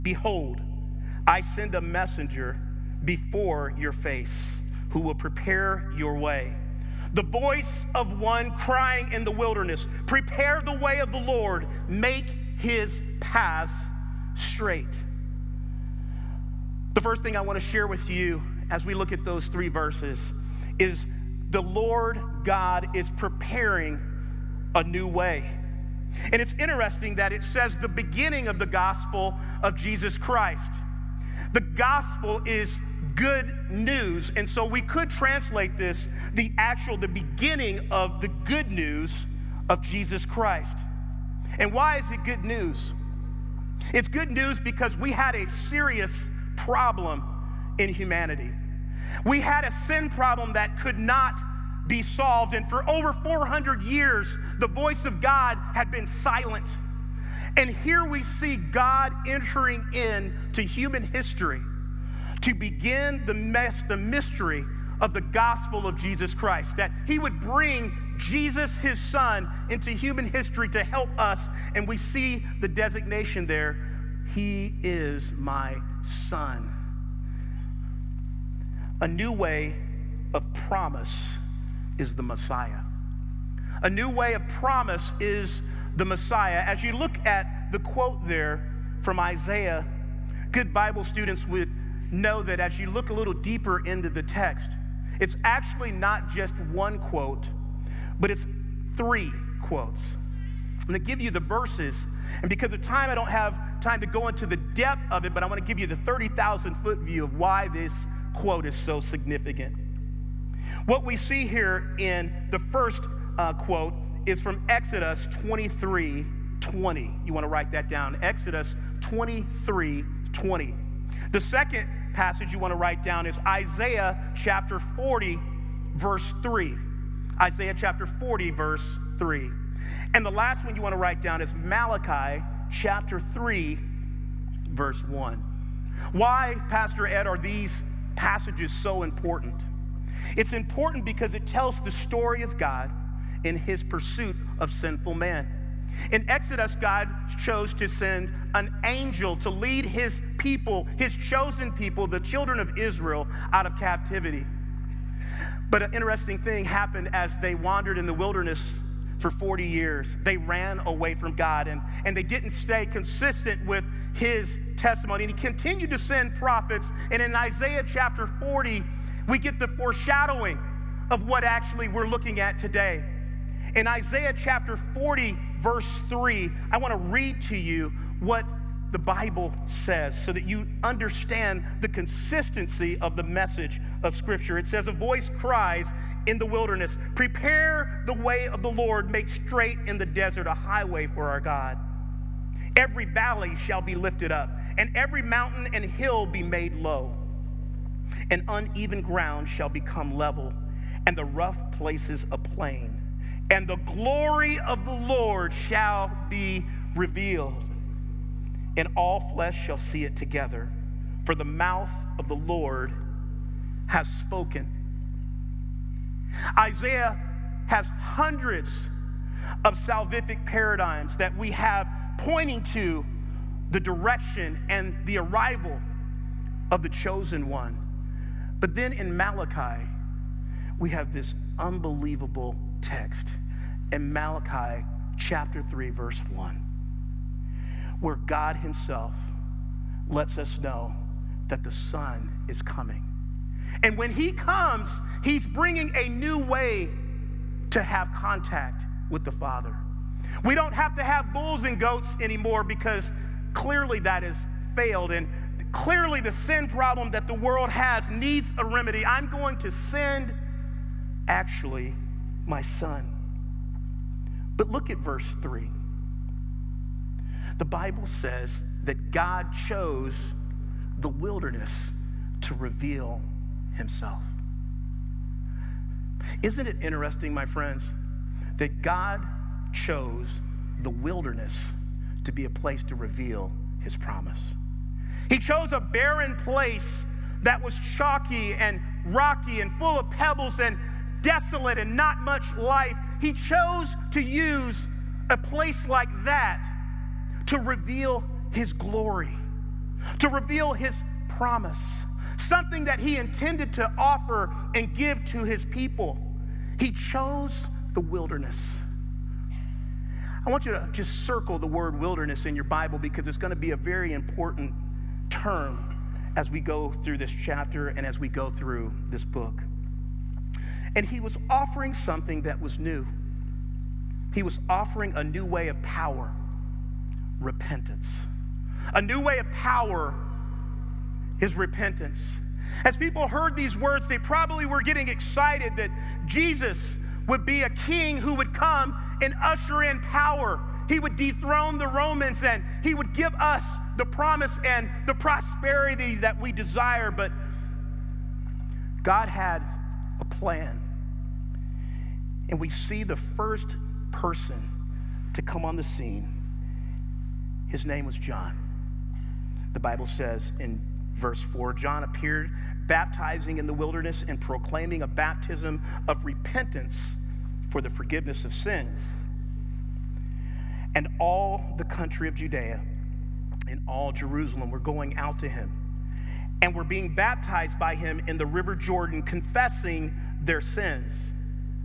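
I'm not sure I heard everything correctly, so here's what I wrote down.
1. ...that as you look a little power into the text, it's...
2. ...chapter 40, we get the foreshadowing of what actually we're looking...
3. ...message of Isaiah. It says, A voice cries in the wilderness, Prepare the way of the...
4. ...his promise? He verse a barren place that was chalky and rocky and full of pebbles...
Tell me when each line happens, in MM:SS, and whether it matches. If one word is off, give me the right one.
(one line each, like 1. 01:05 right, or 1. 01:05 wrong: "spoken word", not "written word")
1. 01:32 wrong: "deeper", not "power"
2. 02:47 right
3. 03:03 wrong: "Scripture", not "Isaiah"
4. 04:43 wrong: "chose", not "verse".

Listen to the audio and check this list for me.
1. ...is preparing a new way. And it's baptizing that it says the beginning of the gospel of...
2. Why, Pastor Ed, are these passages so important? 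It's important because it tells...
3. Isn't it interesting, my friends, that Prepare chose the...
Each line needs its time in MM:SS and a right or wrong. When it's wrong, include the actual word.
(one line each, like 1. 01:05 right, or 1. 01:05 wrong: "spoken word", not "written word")
1. 00:22 wrong: "interesting", not "baptizing"
2. 02:16 right
3. 04:36 wrong: "God", not "Prepare".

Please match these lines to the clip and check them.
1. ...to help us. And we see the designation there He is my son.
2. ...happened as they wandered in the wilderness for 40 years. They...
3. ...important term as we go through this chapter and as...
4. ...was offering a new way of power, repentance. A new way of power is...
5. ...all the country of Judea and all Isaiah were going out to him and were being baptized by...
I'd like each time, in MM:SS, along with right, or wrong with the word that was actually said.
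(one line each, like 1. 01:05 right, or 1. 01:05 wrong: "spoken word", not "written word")
1. 01:10 right
2. 02:36 right
3. 05:14 right
4. 05:24 right
5. 06:11 wrong: "Jerusalem", not "Isaiah".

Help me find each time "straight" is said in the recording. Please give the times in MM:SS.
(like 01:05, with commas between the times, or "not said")
00:14, 03:09.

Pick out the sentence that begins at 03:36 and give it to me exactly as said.
Isaiah has hundreds of salvific paradigms that we have pointing to the direction and the arrival of the chosen one.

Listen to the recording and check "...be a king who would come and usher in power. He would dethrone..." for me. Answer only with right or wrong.
right.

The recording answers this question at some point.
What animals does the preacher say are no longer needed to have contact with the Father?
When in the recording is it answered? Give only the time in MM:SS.
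04:11.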